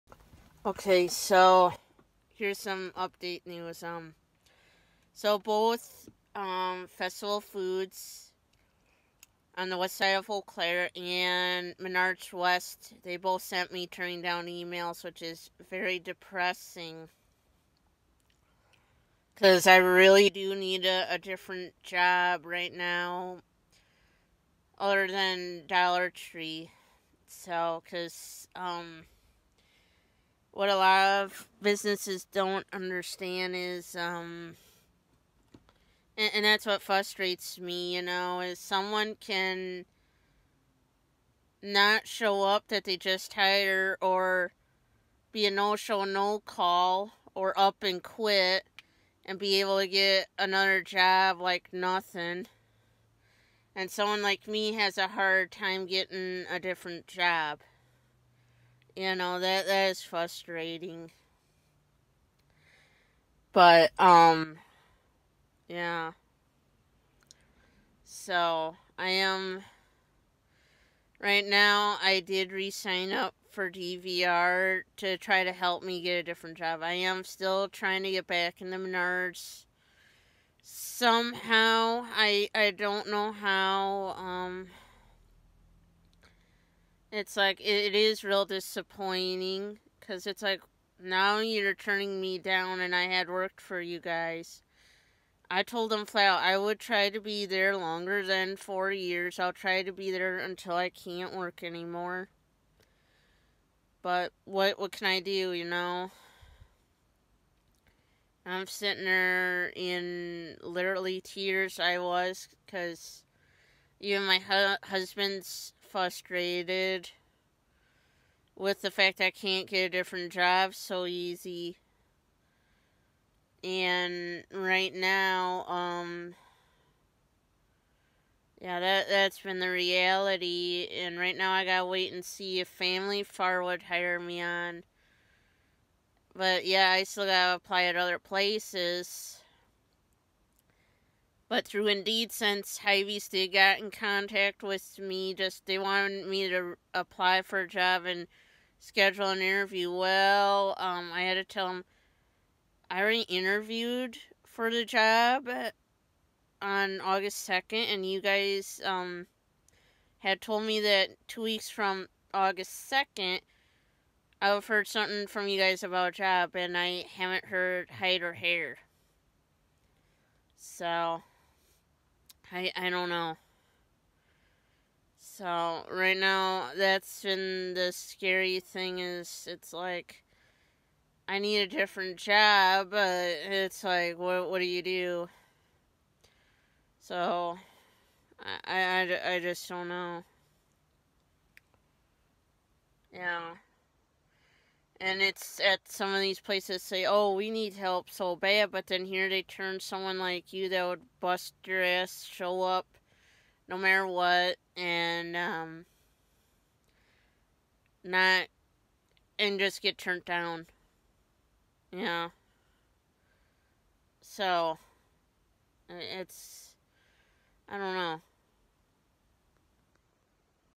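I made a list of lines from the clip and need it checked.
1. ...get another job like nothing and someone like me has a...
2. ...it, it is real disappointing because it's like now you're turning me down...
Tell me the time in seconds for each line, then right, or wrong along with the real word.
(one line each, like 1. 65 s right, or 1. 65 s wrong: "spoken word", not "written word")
1. 49 s right
2. 87 s right.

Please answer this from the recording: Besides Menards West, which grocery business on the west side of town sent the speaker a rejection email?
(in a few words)
Festival Foods.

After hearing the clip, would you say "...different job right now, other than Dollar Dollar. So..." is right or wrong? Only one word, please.
wrong.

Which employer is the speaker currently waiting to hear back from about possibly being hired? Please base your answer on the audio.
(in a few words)
Family Fare.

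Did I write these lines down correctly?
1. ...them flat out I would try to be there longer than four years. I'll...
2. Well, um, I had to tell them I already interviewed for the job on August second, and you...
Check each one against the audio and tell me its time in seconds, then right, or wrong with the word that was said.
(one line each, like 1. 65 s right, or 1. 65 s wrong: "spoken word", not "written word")
1. 95 s right
2. 149 s right.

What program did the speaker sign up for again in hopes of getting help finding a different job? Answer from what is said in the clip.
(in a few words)
DVR.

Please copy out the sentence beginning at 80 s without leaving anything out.
Somehow, I I don't know how.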